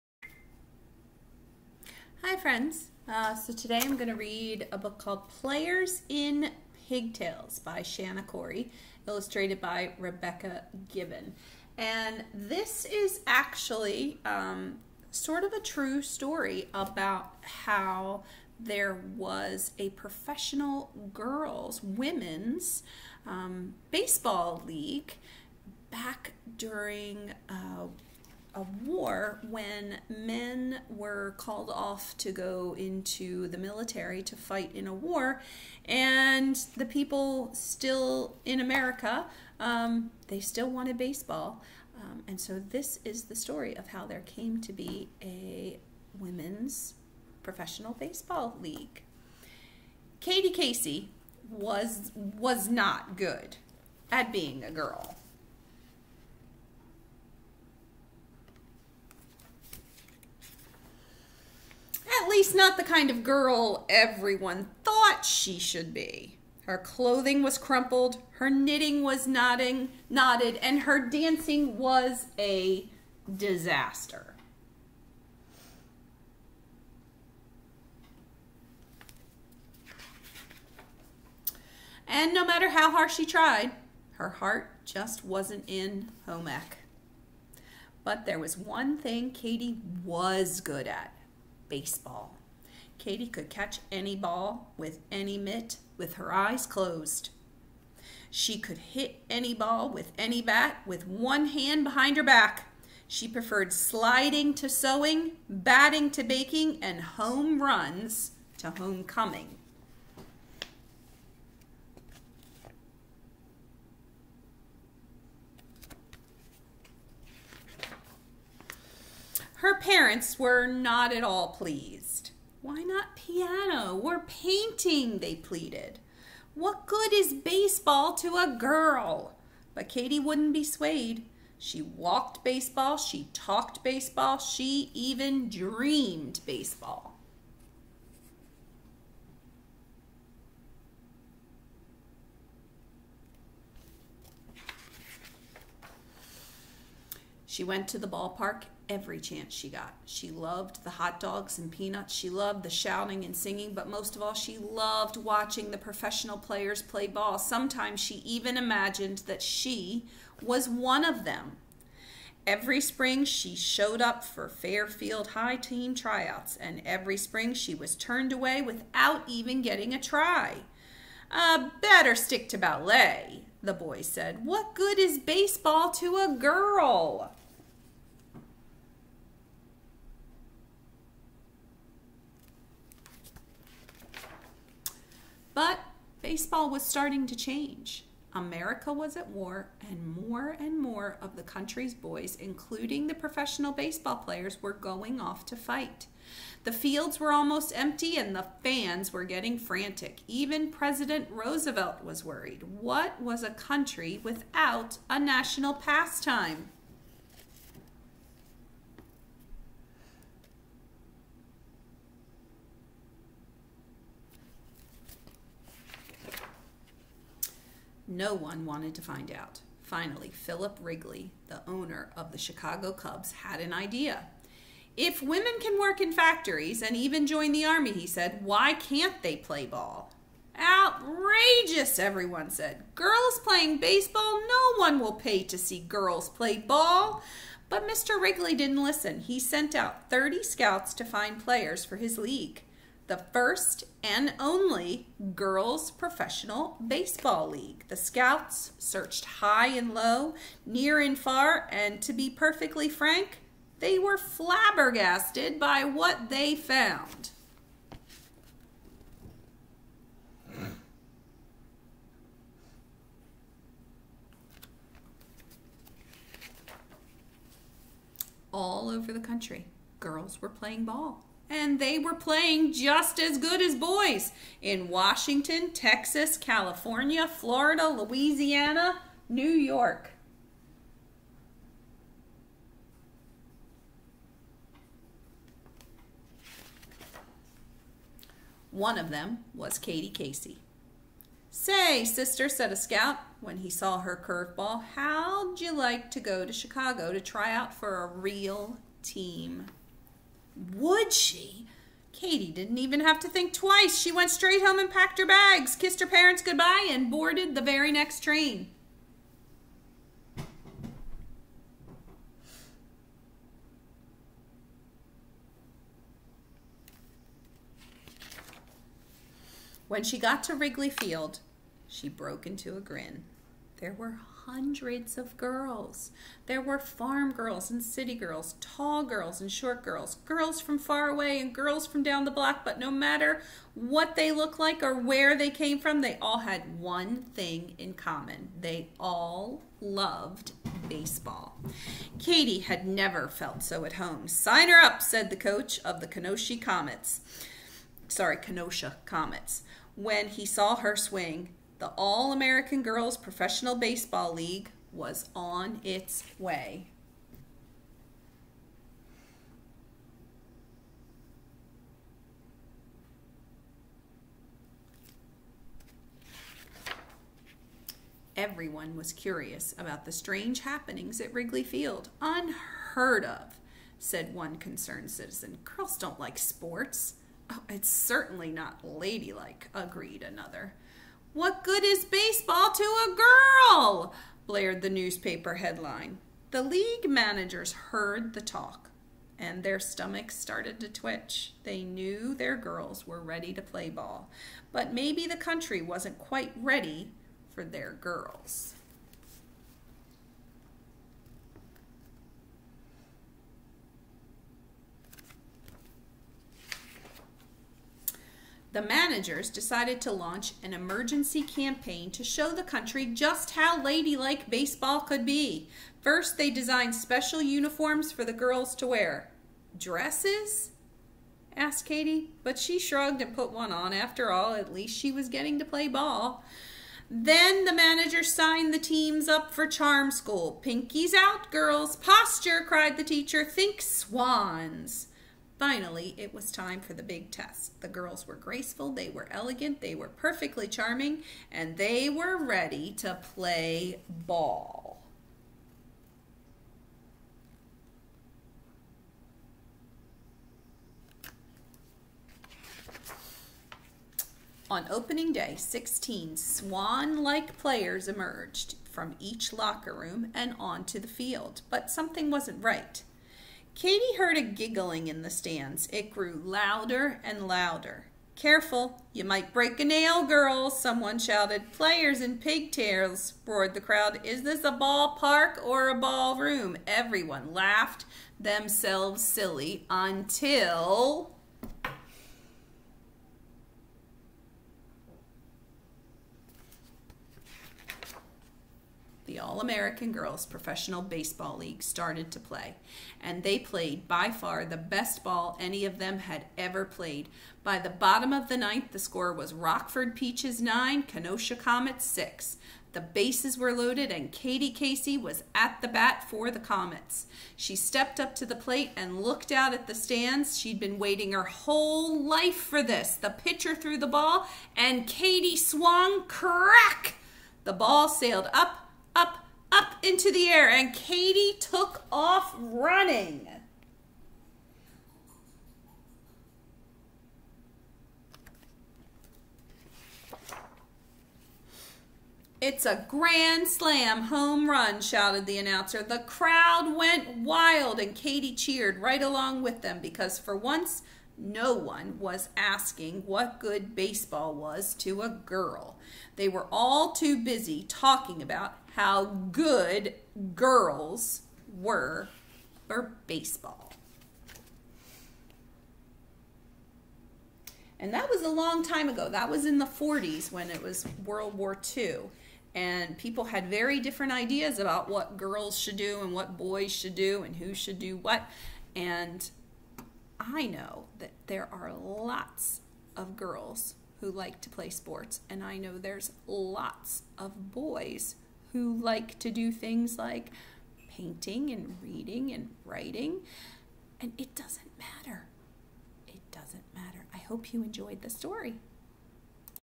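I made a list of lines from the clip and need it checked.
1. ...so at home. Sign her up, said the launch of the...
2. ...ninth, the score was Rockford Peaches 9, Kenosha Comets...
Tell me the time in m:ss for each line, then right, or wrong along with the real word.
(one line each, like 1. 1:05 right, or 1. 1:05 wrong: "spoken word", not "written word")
1. 5:43 wrong: "coach", not "launch"
2. 8:18 right.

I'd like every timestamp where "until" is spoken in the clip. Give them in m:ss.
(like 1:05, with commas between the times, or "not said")
7:59.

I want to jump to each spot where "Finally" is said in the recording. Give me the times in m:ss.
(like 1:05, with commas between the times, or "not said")
3:39, 7:15.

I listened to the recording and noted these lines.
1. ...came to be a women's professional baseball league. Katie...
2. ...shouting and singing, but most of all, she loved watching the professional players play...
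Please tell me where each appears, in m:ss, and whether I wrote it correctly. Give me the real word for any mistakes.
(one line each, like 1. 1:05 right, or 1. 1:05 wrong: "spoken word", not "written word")
1. 0:44 right
2. 2:32 right.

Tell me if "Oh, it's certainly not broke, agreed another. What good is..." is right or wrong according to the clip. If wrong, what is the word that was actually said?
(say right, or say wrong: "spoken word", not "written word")
wrong: "ladylike", not "broke".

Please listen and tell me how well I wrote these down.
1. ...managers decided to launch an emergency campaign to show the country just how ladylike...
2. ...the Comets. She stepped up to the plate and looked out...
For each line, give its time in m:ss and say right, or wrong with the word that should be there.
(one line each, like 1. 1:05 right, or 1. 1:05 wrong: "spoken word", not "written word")
1. 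6:48 right
2. 8:26 right.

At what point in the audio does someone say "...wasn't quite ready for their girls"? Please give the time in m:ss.
6:35.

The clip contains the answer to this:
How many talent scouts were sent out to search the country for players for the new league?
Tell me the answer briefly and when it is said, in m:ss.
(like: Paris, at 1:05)
30, at 4:00.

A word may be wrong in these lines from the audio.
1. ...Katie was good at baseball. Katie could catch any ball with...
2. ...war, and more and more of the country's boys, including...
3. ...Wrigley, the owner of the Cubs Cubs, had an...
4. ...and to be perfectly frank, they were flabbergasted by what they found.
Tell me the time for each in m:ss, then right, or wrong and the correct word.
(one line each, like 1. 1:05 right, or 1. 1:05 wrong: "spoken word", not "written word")
1. 1:29 right
2. 3:09 right
3. 3:40 wrong: "Chicago", not "Cubs"
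4. 4:11 right.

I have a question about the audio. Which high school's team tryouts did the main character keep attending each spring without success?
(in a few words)
Fairfield High.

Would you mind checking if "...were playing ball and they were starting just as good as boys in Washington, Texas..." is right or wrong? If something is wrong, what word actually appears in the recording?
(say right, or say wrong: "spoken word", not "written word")
wrong: "playing", not "starting".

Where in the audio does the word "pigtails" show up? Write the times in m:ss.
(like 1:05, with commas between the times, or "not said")
0:06, 7:52.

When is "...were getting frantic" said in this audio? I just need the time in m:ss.
3:19.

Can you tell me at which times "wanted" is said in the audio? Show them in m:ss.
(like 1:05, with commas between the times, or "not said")
0:40, 3:38.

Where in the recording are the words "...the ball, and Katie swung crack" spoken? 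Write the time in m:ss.
8:33.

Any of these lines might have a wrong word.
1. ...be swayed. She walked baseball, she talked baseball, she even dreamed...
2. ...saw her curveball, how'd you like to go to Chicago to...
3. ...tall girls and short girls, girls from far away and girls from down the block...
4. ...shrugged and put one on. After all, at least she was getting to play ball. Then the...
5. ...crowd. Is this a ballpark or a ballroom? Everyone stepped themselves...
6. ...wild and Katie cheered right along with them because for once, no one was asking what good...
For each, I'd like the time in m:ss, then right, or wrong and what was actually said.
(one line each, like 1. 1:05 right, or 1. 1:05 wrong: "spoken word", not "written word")
1. 2:10 right
2. 4:53 right
3. 5:28 right
4. 7:02 right
5. 7:53 wrong: "laughed", not "stepped"
6. 8:57 right.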